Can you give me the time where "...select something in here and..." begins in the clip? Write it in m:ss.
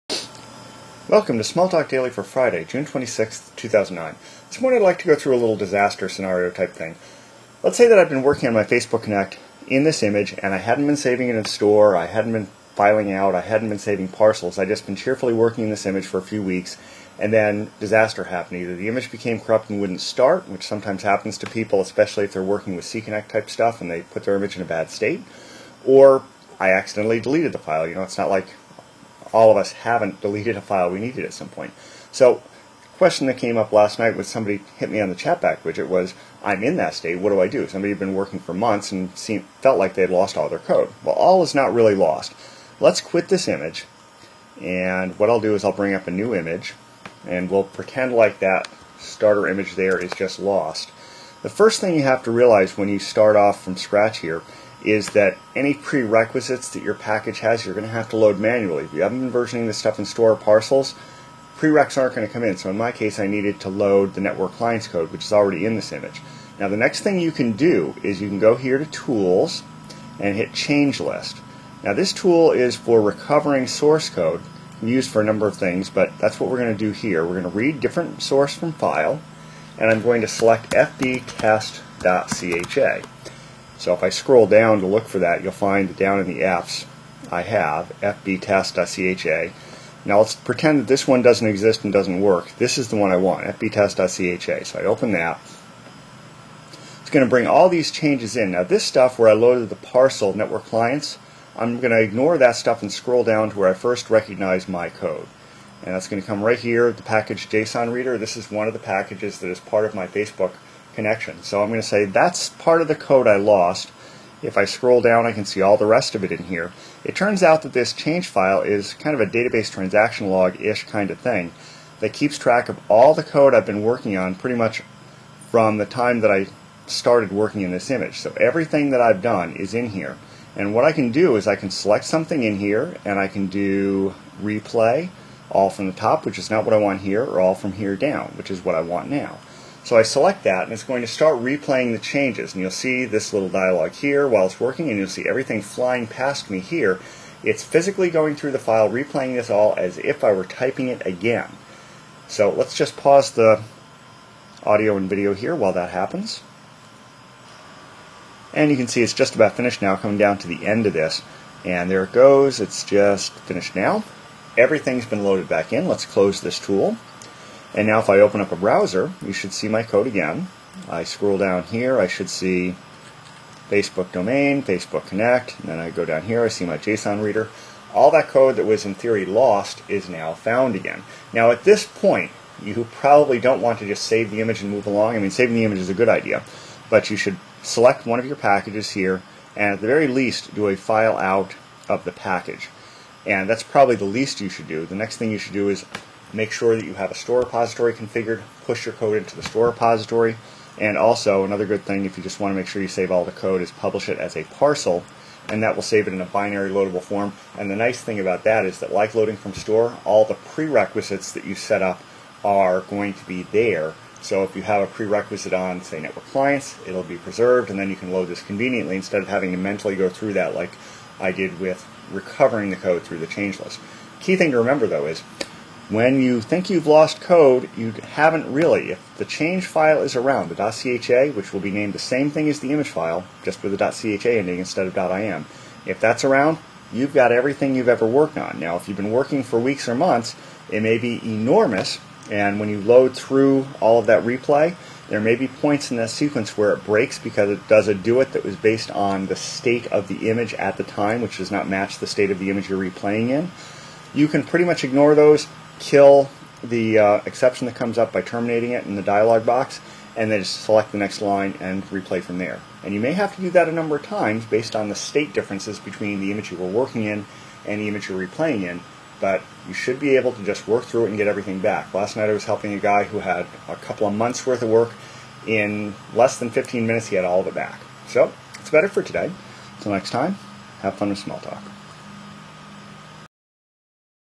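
2:11.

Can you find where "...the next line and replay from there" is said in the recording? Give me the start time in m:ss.
4:20.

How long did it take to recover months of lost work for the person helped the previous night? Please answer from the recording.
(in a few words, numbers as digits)
less than 15 minutes.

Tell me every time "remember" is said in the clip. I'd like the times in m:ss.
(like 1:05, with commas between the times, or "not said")
3:44.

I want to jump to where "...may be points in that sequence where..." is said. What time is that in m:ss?
4:05.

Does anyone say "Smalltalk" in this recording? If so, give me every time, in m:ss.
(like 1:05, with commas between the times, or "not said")
0:01, 4:41.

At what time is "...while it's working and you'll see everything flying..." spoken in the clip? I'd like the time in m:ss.
2:24.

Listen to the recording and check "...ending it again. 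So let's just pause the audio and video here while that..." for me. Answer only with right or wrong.
wrong.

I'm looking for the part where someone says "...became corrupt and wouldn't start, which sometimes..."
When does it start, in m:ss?
0:19.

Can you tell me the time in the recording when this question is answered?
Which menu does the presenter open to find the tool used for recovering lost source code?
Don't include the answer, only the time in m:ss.
1:08.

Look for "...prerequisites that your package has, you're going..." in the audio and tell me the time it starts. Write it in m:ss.
0:55.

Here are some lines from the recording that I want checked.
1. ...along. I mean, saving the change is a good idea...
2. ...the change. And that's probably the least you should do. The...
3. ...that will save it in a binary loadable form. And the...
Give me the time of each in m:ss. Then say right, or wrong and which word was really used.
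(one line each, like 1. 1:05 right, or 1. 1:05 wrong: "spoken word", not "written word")
1. 3:04 wrong: "image", not "change"
2. 3:12 wrong: "package", not "change"
3. 3:25 right.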